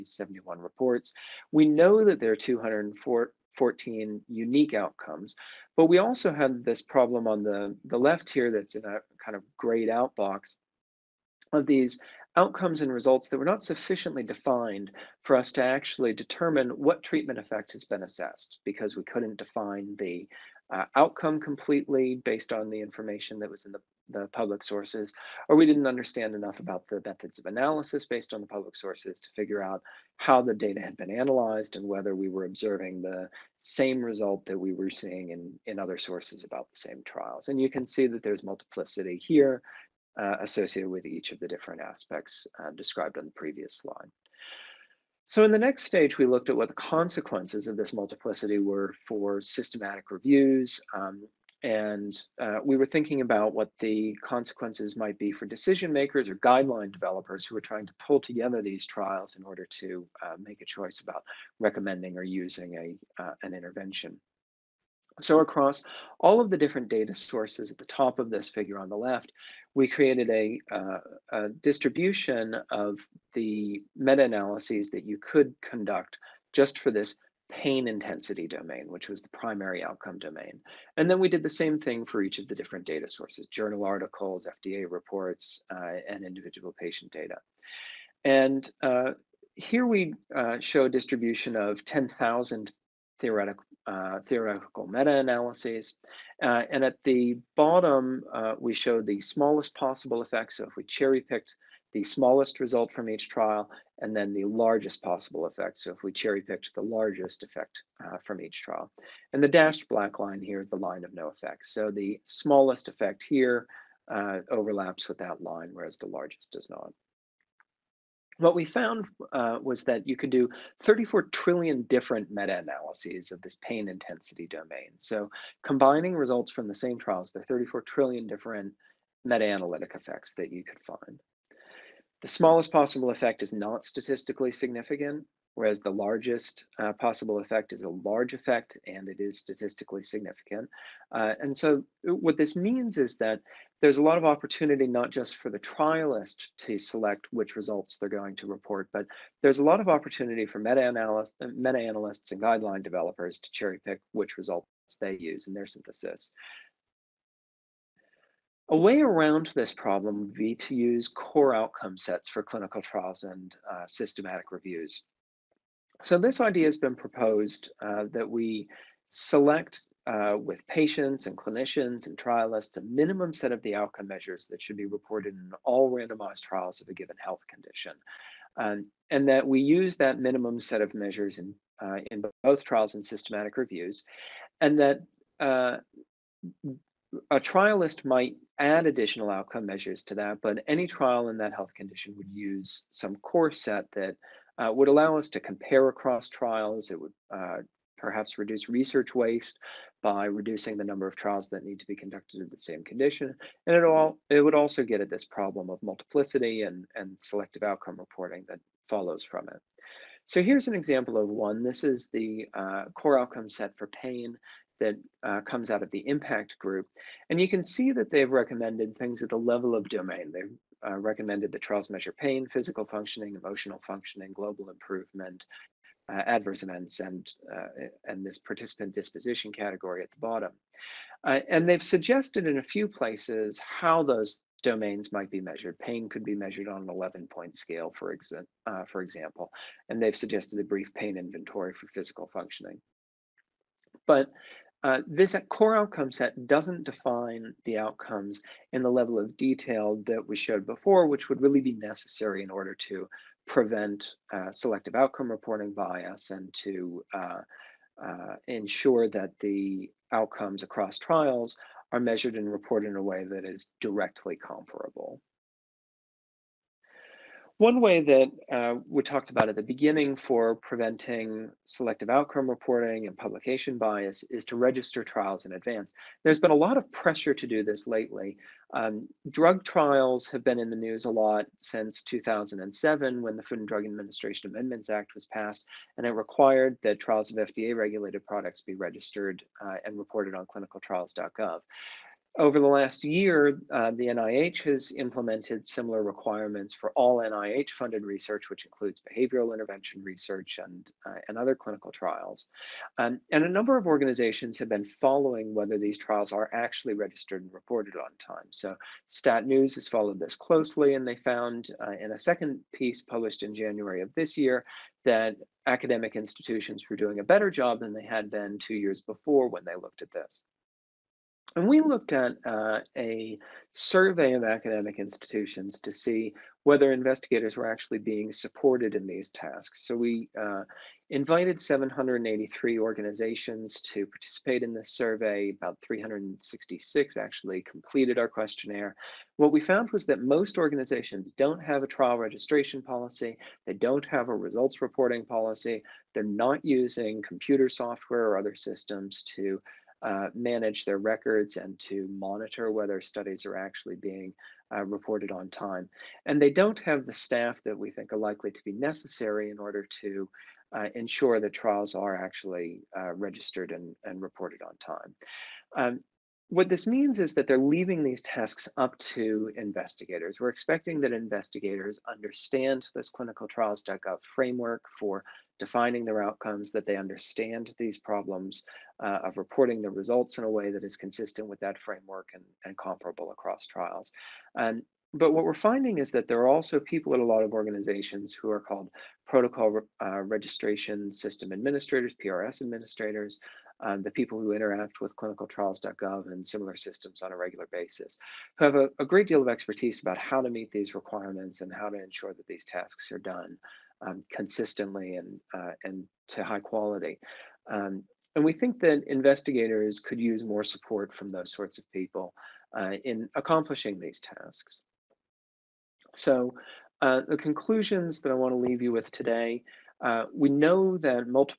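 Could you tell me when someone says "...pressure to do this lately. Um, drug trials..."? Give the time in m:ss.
4:36.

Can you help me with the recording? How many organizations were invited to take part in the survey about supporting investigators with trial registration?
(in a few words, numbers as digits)
783.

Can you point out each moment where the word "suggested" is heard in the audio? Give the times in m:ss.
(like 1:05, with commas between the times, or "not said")
3:51, 4:00.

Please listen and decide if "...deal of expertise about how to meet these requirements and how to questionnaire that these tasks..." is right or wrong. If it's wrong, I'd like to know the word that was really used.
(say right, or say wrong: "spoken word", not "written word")
wrong: "ensure", not "questionnaire".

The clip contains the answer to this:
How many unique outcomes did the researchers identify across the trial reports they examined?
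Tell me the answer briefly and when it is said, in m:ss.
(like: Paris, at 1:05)
214, at 0:02.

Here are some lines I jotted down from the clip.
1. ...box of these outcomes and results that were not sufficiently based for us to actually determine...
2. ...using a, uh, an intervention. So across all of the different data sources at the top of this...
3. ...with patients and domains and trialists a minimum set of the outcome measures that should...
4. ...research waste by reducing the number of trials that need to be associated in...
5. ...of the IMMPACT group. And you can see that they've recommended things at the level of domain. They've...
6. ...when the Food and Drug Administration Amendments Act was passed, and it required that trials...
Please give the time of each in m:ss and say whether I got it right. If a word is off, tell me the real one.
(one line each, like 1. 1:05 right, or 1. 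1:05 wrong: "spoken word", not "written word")
1. 0:10 wrong: "defined", not "based"
2. 1:02 right
3. 2:50 wrong: "clinicians", not "domains"
4. 3:18 wrong: "conducted", not "associated"
5. 3:35 right
6. 4:43 right.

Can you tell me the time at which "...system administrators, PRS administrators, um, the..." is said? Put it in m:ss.
6:31.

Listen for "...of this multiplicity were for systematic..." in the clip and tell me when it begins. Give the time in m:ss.
0:47.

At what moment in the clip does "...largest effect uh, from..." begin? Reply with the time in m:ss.
1:46.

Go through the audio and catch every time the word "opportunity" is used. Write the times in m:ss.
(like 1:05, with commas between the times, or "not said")
2:24, 2:29.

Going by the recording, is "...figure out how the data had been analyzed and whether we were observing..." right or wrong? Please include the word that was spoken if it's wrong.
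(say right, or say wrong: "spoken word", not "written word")
right.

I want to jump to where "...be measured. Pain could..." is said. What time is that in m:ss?
3:55.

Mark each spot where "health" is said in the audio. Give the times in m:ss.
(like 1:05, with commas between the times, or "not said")
2:57, 3:11.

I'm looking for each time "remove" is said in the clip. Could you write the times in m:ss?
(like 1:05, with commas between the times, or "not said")
not said.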